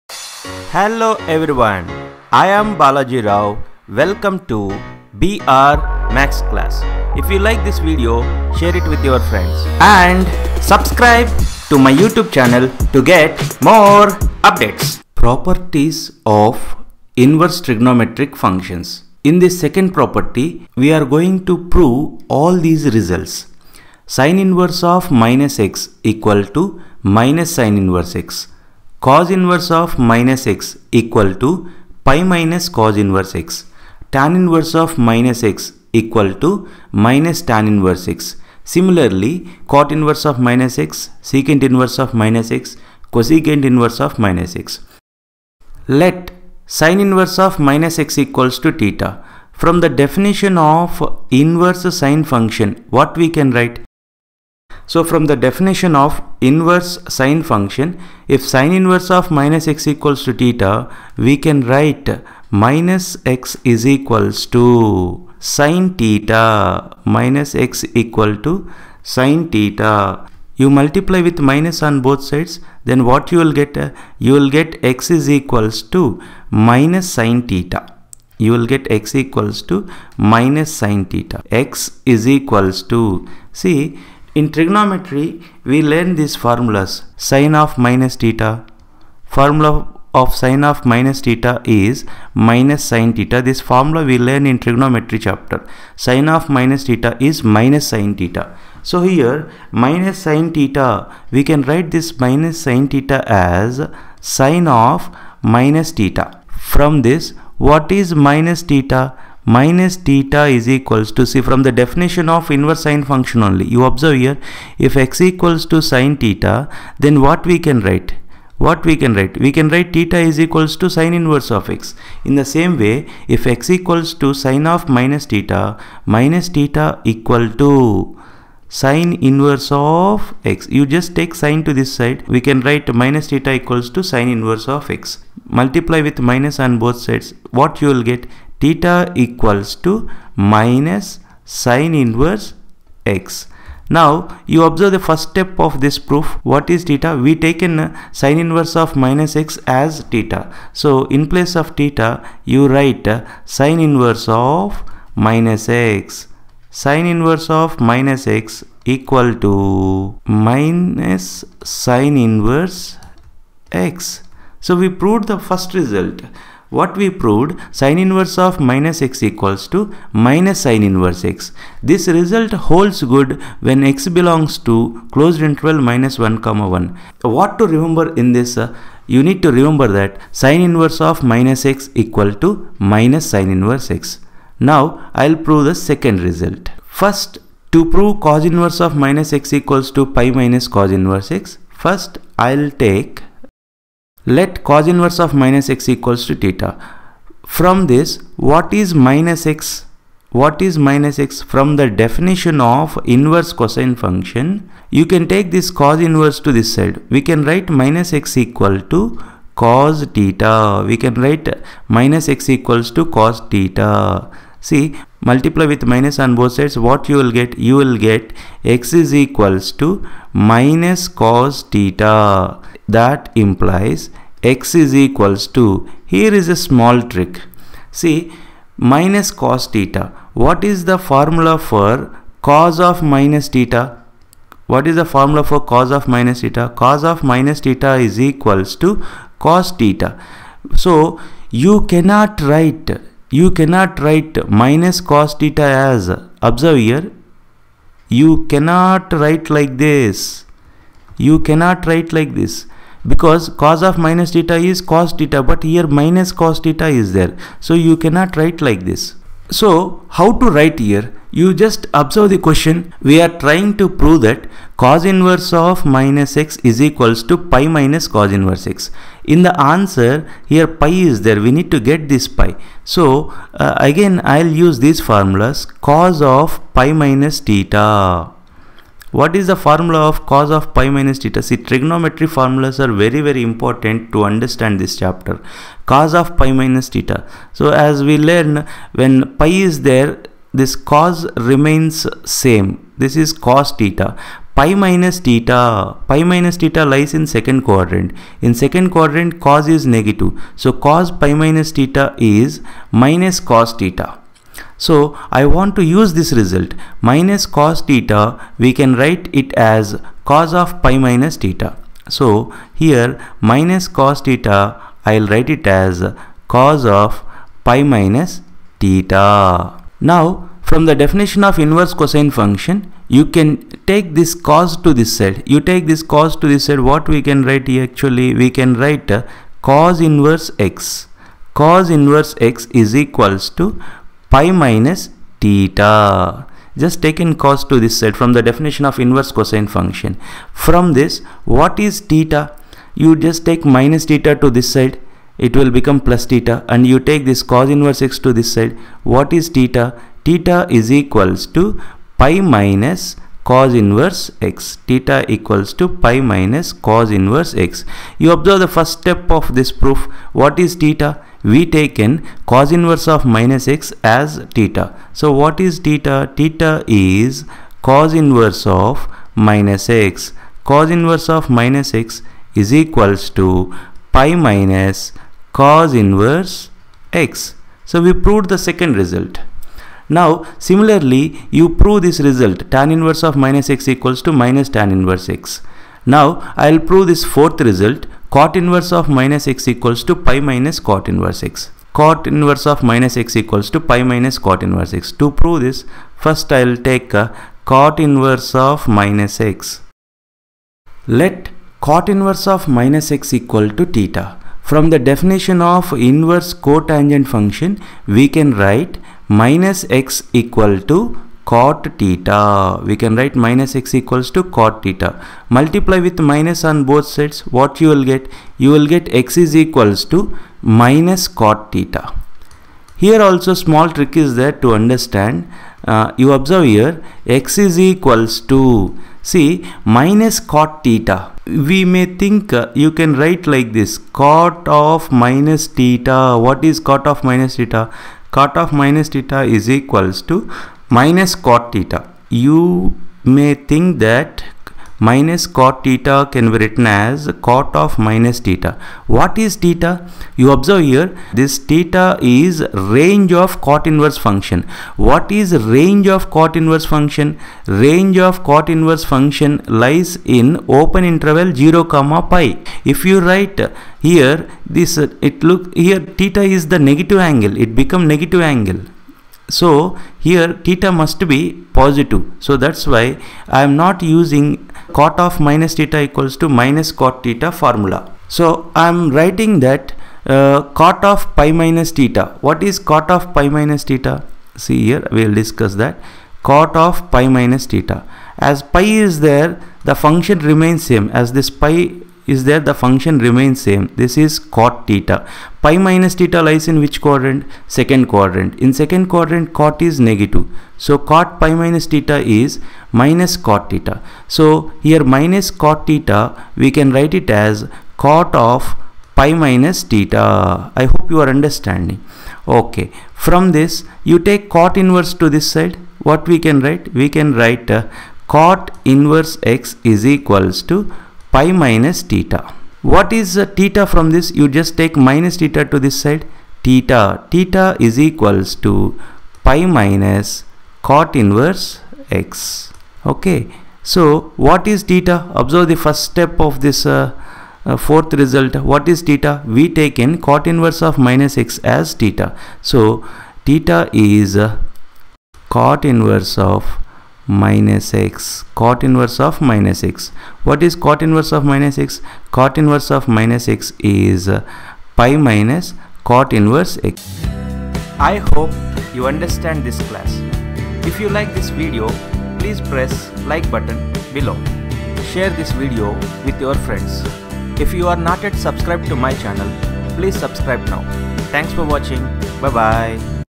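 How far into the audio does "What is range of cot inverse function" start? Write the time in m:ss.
7:34.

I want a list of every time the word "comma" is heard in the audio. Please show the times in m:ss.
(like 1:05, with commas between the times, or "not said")
2:56, 7:41.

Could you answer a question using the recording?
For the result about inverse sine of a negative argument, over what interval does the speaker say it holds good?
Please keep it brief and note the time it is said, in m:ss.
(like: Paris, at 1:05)
closed interval -1 to 1, at 2:55.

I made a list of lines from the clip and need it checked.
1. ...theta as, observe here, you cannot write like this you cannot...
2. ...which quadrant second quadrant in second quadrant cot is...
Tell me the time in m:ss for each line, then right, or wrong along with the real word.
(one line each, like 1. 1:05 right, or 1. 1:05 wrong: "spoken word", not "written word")
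1. 4:05 right
2. 8:16 right.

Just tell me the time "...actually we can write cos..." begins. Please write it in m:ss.
5:27.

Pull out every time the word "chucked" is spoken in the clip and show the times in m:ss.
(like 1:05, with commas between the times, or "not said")
not said.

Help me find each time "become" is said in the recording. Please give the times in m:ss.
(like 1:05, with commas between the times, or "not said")
5:45, 7:47.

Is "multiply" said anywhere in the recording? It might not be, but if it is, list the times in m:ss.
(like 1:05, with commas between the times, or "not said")
1:10, 2:15, 3:35, 6:55.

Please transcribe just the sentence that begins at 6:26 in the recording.
Now I will prove this fourth result cot inverse of minus x equals to pi minus cot inverse x.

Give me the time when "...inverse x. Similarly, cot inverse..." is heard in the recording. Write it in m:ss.
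0:37.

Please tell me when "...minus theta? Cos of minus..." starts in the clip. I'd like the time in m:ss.
3:56.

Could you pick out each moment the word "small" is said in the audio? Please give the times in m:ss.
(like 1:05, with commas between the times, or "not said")
3:46, 7:03.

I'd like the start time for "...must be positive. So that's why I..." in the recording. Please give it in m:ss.
7:50.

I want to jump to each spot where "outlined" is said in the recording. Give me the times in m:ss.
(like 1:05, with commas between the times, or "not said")
not said.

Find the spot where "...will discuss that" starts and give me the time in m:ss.
8:05.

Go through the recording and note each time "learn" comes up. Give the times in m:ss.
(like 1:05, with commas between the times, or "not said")
1:25, 1:34, 4:48.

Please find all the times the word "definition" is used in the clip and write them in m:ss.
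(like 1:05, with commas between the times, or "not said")
0:49, 0:55, 1:51, 3:21, 5:20, 5:38, 6:45.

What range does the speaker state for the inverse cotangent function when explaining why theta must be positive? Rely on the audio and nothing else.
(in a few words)
open interval 0 to pi.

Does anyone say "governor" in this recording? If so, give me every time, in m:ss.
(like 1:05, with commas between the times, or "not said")
not said.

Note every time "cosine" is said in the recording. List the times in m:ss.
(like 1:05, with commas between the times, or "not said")
3:23, 5:21, 5:39.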